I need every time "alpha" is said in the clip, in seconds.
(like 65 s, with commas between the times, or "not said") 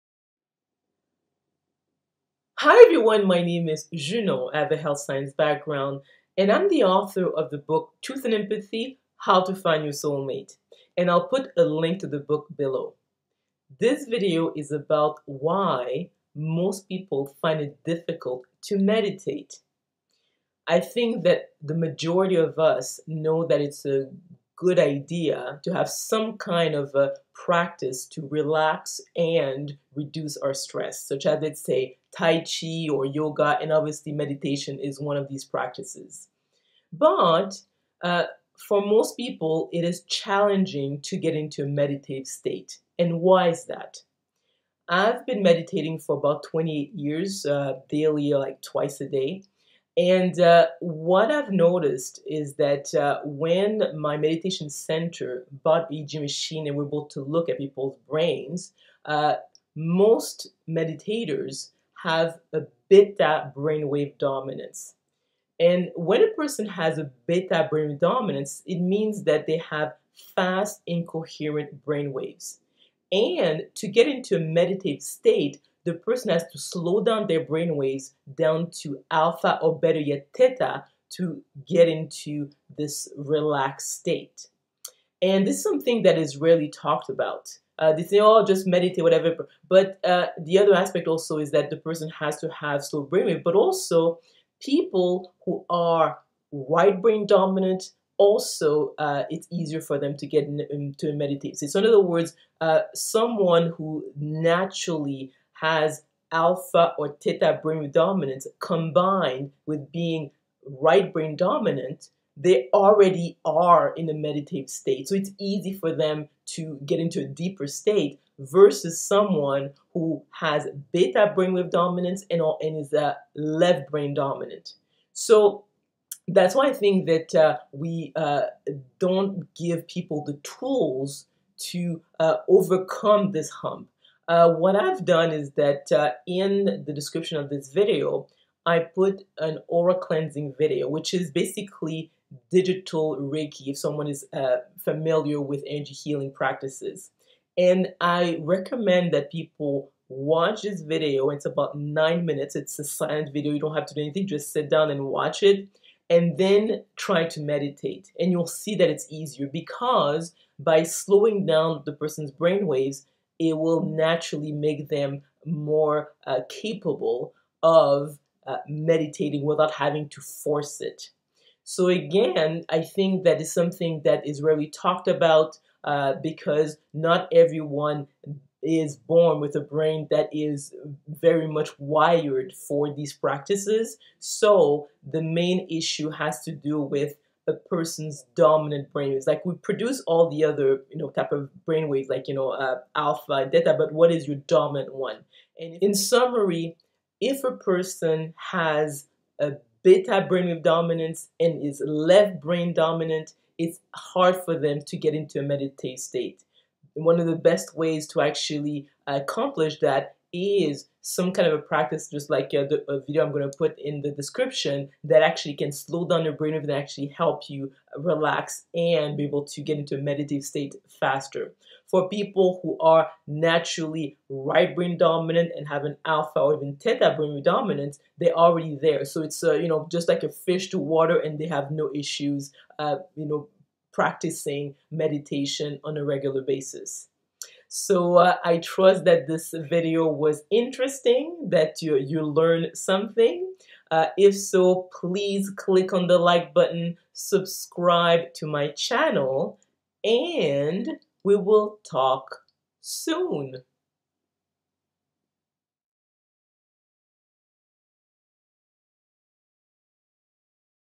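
79 s, 106 s, 192 s, 226 s.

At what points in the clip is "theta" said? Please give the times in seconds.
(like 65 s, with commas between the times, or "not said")
80 s, 107 s, 226 s.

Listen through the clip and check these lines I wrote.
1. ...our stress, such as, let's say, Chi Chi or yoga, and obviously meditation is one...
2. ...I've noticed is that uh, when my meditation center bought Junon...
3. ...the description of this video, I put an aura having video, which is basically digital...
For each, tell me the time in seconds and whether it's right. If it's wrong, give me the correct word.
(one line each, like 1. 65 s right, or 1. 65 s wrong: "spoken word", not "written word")
1. 30 s wrong: "Tai", not "Chi"
2. 51 s wrong: "EEG", not "Junon"
3. 136 s wrong: "cleansing", not "having".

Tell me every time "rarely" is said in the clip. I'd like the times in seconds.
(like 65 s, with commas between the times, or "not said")
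86 s, 174 s.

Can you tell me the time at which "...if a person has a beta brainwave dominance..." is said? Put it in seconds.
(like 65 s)
197 s.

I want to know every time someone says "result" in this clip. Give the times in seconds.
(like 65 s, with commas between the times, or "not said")
not said.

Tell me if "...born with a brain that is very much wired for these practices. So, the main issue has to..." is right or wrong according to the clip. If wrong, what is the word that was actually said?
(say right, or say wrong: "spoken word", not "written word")
right.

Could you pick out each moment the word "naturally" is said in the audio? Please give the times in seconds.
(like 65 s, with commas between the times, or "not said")
104 s, 163 s, 223 s.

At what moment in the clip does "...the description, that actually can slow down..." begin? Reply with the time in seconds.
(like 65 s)
214 s.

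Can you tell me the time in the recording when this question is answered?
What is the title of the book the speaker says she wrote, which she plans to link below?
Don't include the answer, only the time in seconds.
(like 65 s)
8 s.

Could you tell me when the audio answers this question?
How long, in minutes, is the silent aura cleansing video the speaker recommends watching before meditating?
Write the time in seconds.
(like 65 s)
151 s.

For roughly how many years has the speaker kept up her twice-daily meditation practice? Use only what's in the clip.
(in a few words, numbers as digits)
28.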